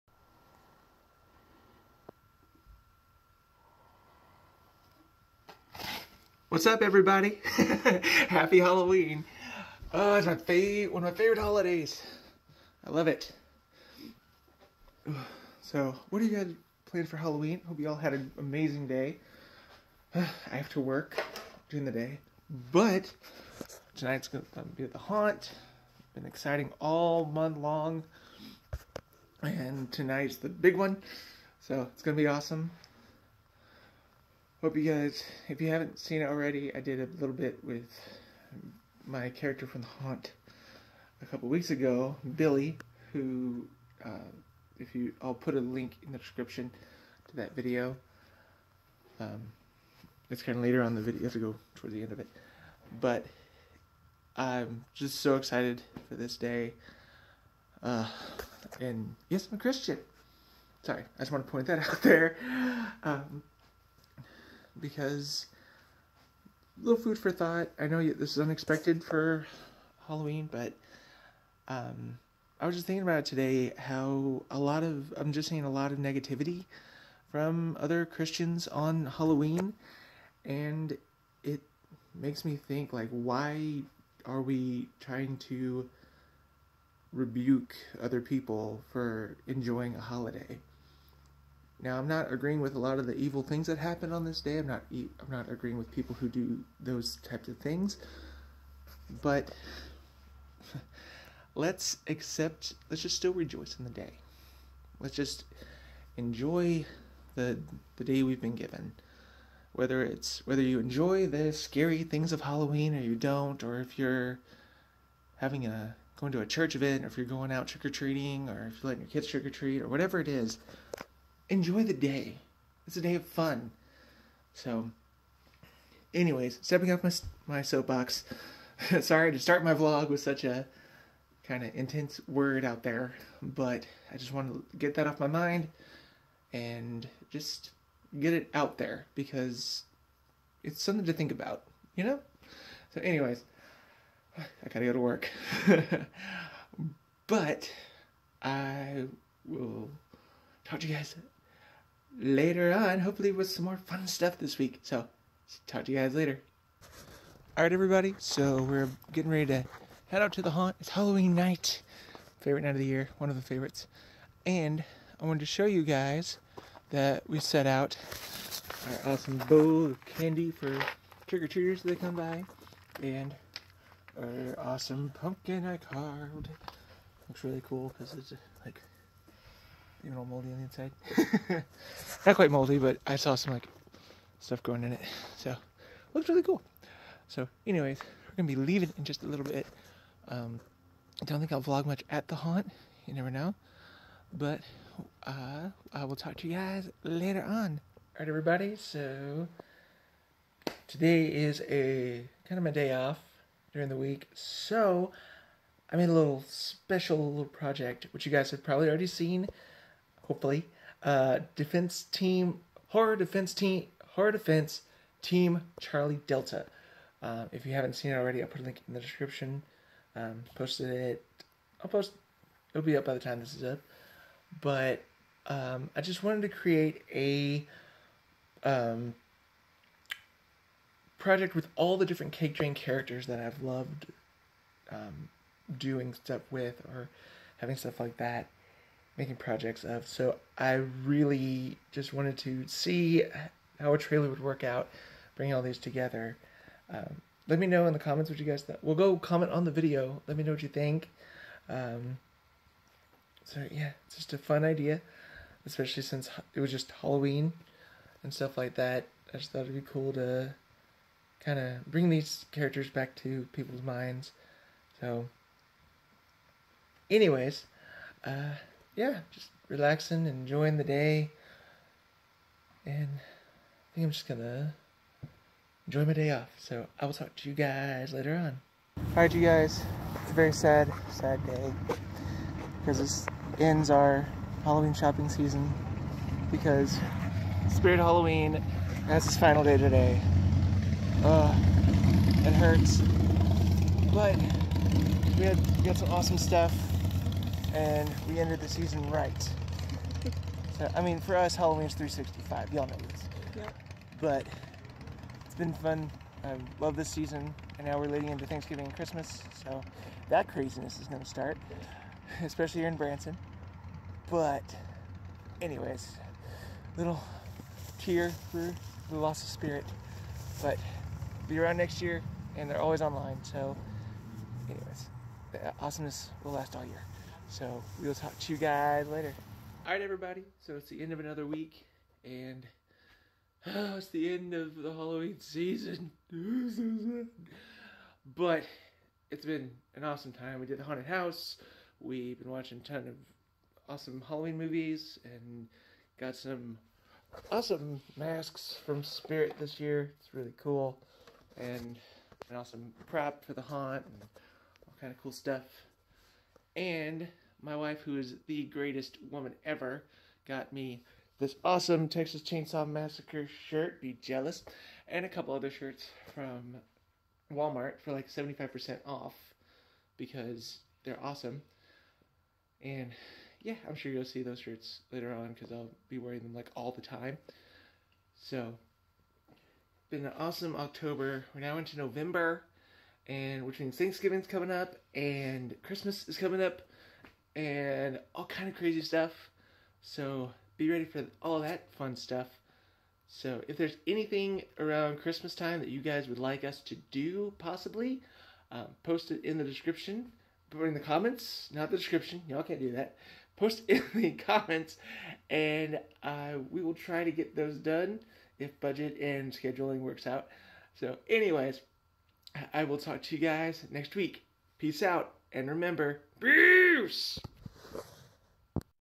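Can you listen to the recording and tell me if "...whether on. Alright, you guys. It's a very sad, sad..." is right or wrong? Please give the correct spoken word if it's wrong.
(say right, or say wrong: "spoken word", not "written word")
wrong: "later", not "whether".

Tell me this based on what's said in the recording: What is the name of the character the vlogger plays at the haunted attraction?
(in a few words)
Billy.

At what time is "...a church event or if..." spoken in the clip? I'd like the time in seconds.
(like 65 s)
116 s.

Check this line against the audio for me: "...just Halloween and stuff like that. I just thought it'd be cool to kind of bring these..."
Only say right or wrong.
right.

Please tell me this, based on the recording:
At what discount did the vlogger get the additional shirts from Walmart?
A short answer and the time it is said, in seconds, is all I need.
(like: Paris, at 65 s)
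75% off, at 368 s.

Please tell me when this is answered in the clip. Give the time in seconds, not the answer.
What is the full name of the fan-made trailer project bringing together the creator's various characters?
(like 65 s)
214 s.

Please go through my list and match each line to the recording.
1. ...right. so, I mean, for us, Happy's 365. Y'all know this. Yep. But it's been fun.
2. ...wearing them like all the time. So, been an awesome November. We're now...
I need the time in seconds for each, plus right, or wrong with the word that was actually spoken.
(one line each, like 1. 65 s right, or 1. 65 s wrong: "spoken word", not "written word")
1. 299 s wrong: "Halloween", not "Happy"
2. 376 s wrong: "October", not "November".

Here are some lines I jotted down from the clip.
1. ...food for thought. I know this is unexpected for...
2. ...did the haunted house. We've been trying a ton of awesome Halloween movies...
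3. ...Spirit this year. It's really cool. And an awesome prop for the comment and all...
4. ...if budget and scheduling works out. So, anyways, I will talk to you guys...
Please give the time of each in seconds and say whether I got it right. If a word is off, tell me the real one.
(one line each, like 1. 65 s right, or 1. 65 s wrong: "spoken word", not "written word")
1. 67 s right
2. 340 s wrong: "watching", not "trying"
3. 349 s wrong: "haunt", not "comment"
4. 408 s right.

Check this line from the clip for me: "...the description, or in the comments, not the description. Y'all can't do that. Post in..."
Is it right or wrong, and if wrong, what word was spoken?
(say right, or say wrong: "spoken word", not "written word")
right.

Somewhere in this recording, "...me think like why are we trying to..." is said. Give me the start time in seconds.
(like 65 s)
82 s.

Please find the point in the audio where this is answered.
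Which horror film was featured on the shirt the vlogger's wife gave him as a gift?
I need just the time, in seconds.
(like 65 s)
362 s.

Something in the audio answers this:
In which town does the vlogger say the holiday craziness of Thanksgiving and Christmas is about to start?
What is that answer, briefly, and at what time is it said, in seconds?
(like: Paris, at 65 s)
Branson, at 312 s.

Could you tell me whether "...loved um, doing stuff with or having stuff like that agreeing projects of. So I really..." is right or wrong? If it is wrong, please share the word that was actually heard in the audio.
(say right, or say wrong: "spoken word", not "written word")
wrong: "making", not "agreeing".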